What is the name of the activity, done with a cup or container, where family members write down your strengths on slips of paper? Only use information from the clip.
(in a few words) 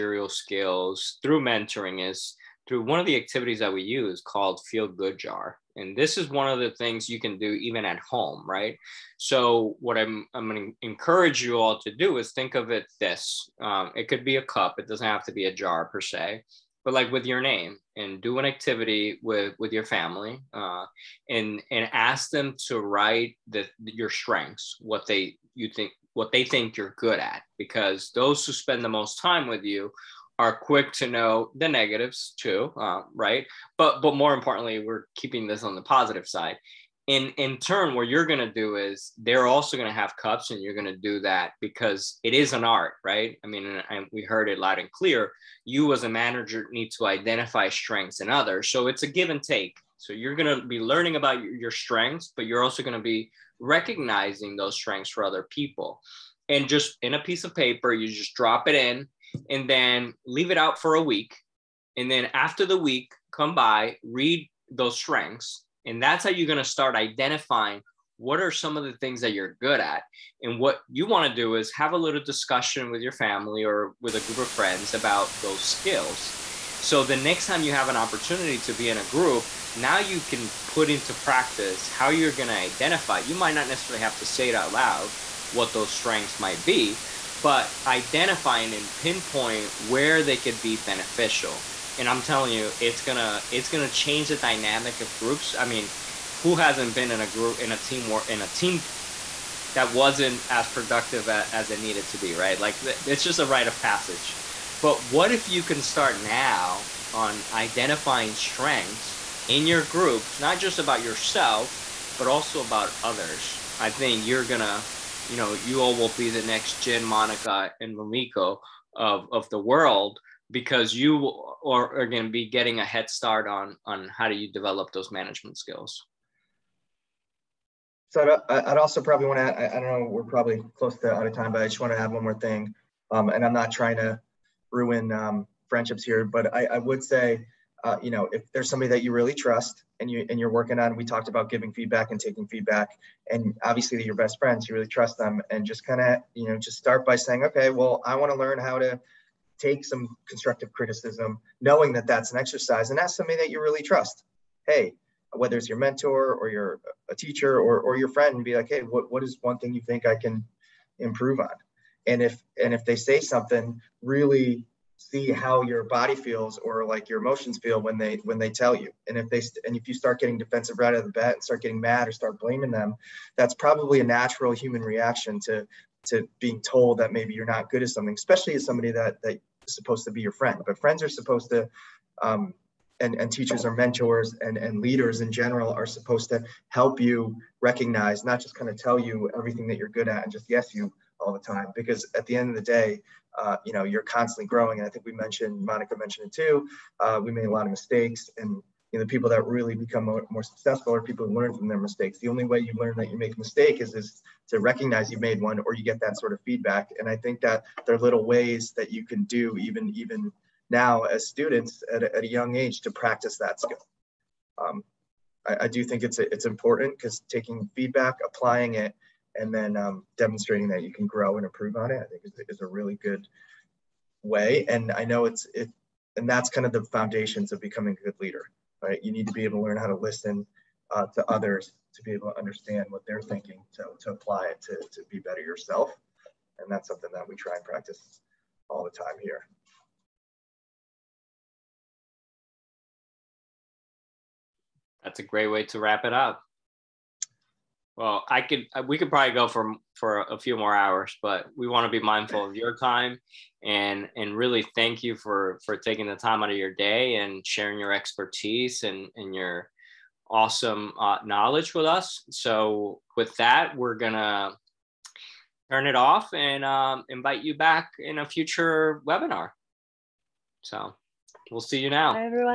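Feel good jar.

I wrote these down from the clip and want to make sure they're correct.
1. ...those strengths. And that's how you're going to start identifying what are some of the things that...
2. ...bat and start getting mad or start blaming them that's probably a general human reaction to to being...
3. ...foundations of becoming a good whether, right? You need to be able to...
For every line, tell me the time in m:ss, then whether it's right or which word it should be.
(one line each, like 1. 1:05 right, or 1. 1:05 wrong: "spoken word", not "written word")
1. 1:04 right
2. 2:51 wrong: "natural", not "general"
3. 3:46 wrong: "leader", not "whether".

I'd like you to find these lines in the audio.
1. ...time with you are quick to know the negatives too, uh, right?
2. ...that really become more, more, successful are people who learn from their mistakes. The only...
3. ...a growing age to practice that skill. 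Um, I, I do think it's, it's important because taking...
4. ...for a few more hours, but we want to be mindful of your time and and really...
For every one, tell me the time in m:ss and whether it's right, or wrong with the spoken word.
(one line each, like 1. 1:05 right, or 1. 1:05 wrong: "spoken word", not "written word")
1. 0:29 right
2. 3:19 right
3. 3:32 wrong: "young", not "growing"
4. 4:09 right.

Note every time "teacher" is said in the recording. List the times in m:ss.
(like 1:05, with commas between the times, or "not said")
2:37, 3:03.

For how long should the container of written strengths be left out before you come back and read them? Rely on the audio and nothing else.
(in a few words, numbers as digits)
A week.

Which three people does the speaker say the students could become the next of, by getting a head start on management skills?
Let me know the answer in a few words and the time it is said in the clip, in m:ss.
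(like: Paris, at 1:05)
Jin, Monica, and Mamiko, at 1:56.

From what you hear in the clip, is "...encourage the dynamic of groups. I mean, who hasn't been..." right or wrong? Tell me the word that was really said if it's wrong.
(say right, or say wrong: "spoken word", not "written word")
wrong: "change", not "encourage".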